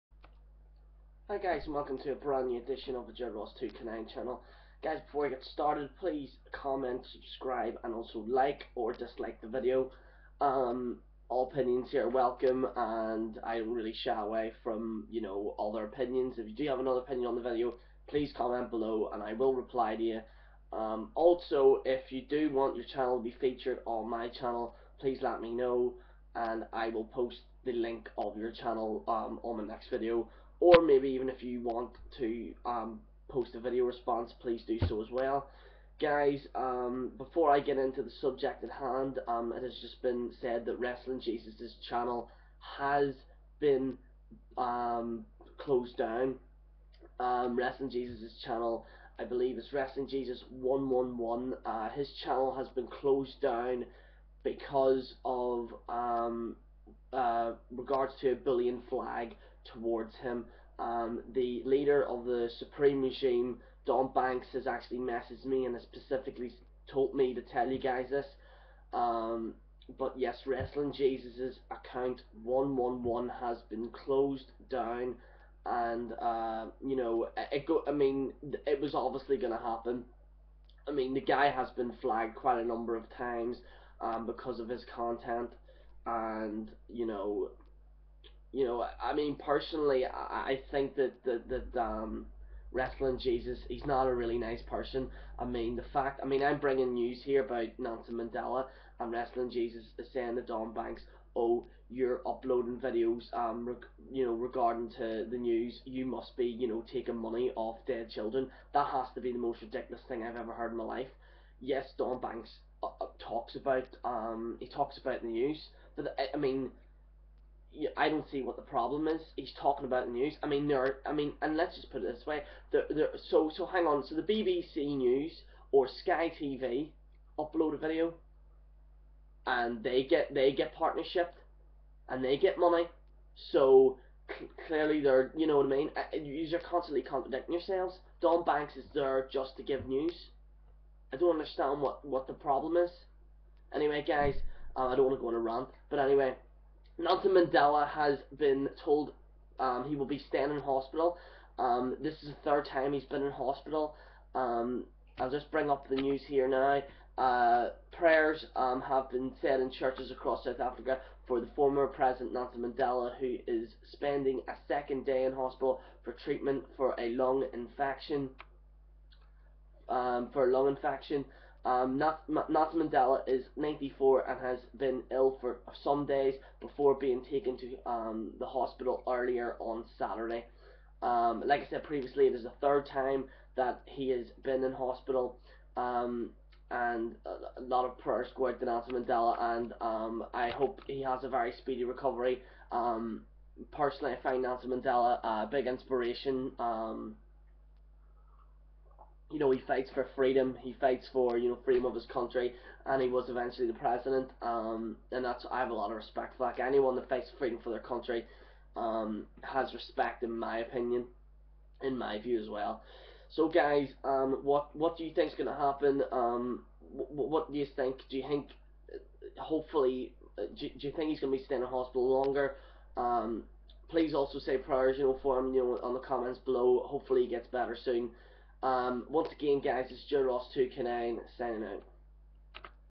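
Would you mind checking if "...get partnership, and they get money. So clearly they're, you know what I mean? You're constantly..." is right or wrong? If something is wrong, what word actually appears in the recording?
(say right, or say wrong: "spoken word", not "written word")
right.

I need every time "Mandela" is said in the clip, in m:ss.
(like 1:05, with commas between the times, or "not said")
1:38, 2:27, 2:42, 2:52, 3:08, 3:14.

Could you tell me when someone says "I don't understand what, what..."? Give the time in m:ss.
2:21.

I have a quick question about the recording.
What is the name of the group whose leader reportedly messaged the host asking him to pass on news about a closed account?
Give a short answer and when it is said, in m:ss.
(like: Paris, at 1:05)
Supreme regime, at 1:02.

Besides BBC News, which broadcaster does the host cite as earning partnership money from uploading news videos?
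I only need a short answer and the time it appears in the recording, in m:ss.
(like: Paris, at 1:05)
Sky TV, at 2:06.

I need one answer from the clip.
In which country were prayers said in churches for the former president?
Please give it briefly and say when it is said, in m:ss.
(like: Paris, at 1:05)
South Africa, at 2:40.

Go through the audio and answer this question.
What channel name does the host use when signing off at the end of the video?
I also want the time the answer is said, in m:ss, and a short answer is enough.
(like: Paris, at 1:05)
Joe Ross2K9, at 3:50.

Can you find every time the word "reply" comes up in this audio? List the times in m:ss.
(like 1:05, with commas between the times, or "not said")
0:19.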